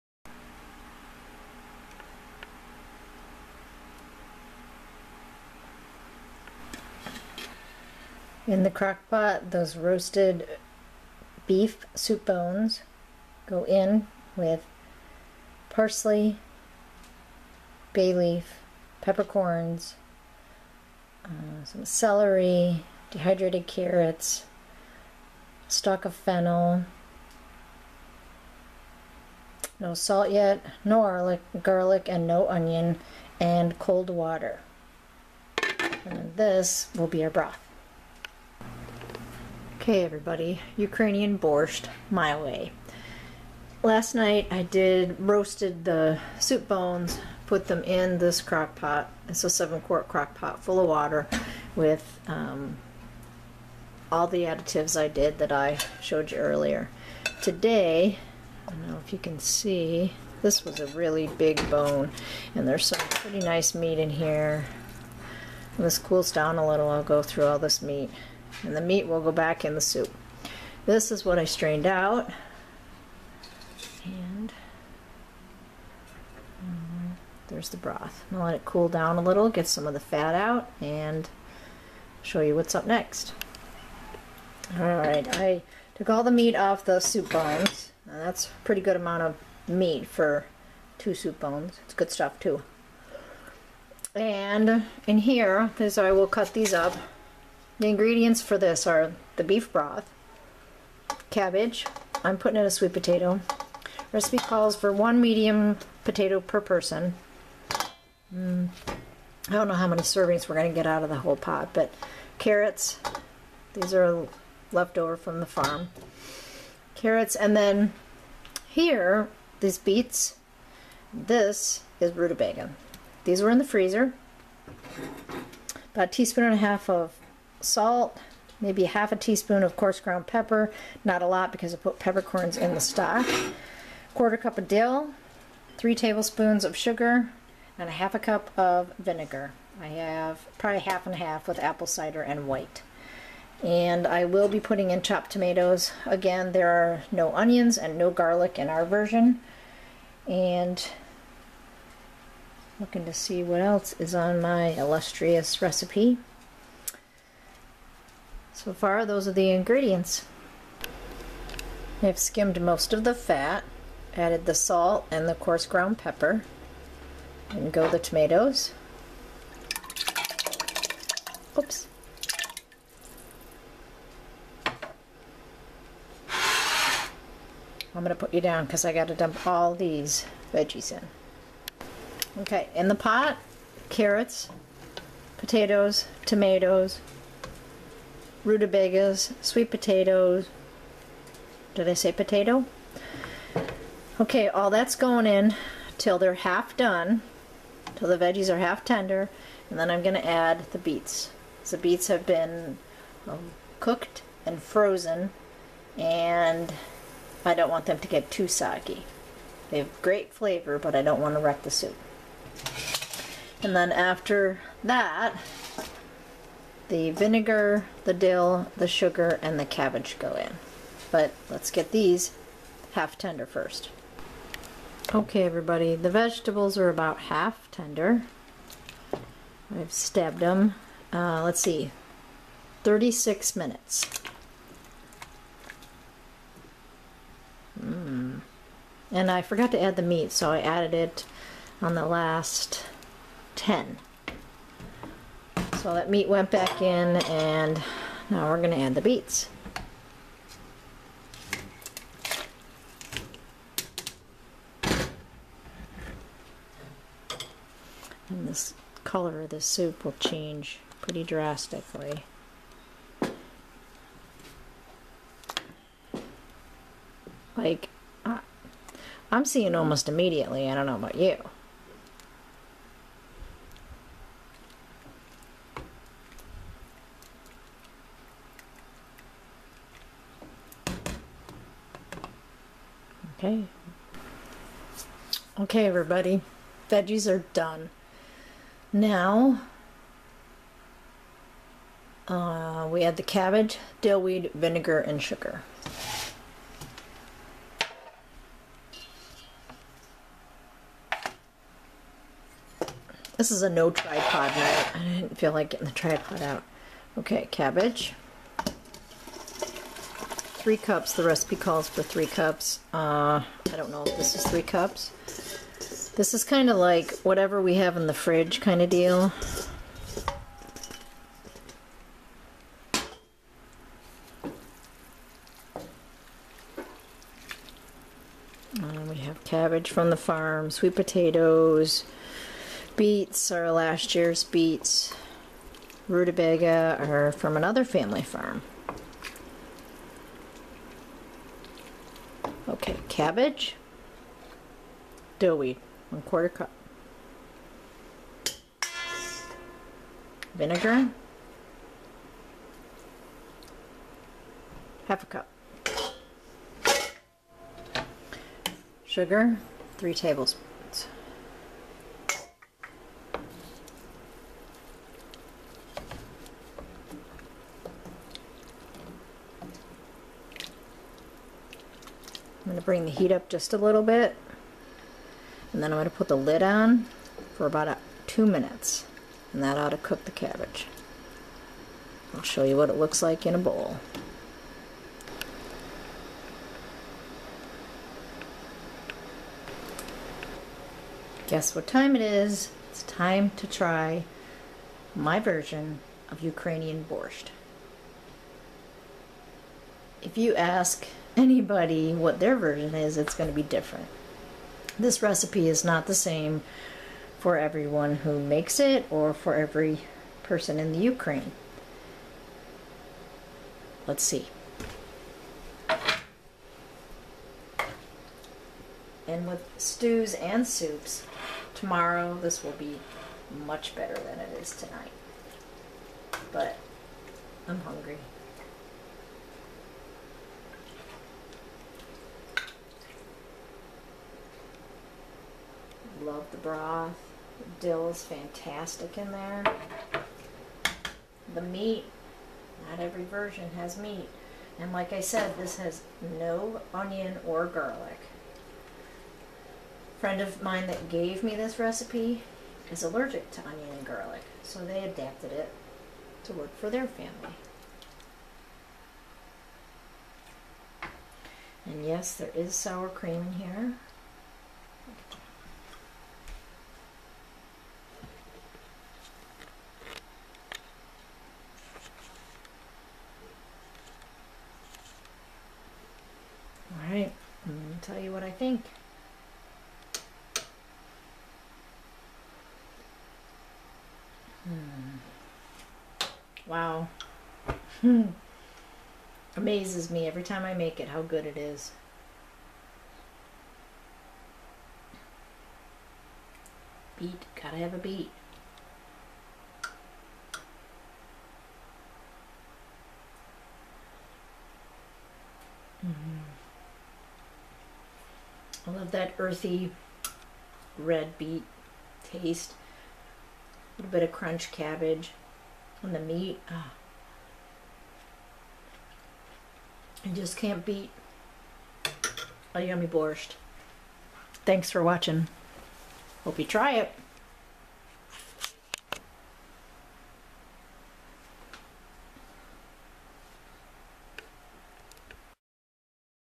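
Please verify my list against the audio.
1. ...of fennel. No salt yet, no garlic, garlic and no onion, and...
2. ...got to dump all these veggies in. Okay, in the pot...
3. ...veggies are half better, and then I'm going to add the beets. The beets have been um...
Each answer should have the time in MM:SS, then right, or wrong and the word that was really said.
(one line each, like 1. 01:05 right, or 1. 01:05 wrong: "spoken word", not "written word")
1. 00:26 right
2. 02:58 right
3. 03:18 wrong: "tender", not "better".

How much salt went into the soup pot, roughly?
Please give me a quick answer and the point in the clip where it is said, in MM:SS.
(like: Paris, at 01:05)
1.5 teaspoons, at 02:06.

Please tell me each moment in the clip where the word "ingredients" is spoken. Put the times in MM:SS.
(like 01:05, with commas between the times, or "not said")
01:37, 02:39.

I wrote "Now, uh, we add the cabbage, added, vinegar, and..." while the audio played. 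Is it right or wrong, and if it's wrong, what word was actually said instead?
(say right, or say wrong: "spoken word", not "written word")
wrong: "dillweed", not "added".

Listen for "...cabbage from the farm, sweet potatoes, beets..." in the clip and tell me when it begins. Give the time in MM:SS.
05:29.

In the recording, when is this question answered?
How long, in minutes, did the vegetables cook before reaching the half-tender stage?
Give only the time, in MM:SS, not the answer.
03:52.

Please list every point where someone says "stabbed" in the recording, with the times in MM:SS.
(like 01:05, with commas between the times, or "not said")
03:49.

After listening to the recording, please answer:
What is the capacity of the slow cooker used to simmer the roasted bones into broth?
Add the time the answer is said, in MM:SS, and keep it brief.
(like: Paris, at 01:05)
7 quart, at 00:49.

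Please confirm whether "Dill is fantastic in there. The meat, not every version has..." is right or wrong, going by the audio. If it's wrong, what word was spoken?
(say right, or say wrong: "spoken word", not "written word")
right.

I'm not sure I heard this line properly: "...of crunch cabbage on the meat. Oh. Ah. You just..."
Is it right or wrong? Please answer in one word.
right.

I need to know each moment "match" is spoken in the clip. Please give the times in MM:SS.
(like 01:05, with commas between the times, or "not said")
not said.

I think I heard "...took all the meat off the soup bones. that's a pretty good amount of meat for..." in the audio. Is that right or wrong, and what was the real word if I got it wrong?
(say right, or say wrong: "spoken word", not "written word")
right.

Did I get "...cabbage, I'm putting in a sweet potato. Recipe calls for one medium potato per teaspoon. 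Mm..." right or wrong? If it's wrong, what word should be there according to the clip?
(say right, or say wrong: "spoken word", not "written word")
wrong: "person", not "teaspoon".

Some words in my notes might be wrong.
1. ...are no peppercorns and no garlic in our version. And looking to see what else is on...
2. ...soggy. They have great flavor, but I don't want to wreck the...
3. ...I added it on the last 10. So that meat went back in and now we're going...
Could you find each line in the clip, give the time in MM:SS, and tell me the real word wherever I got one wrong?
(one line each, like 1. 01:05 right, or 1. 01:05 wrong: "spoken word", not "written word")
1. 02:26 wrong: "onions", not "peppercorns"
2. 03:28 right
3. 04:00 right.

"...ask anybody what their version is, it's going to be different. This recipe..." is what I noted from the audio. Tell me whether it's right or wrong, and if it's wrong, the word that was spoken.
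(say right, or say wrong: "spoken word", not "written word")
right.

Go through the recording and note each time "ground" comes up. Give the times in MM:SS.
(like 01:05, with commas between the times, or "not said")
02:09, 02:45.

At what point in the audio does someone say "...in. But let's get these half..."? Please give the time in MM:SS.
03:40.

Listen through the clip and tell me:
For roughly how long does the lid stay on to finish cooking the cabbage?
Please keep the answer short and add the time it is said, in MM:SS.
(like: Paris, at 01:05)
2 minutes, at 06:18.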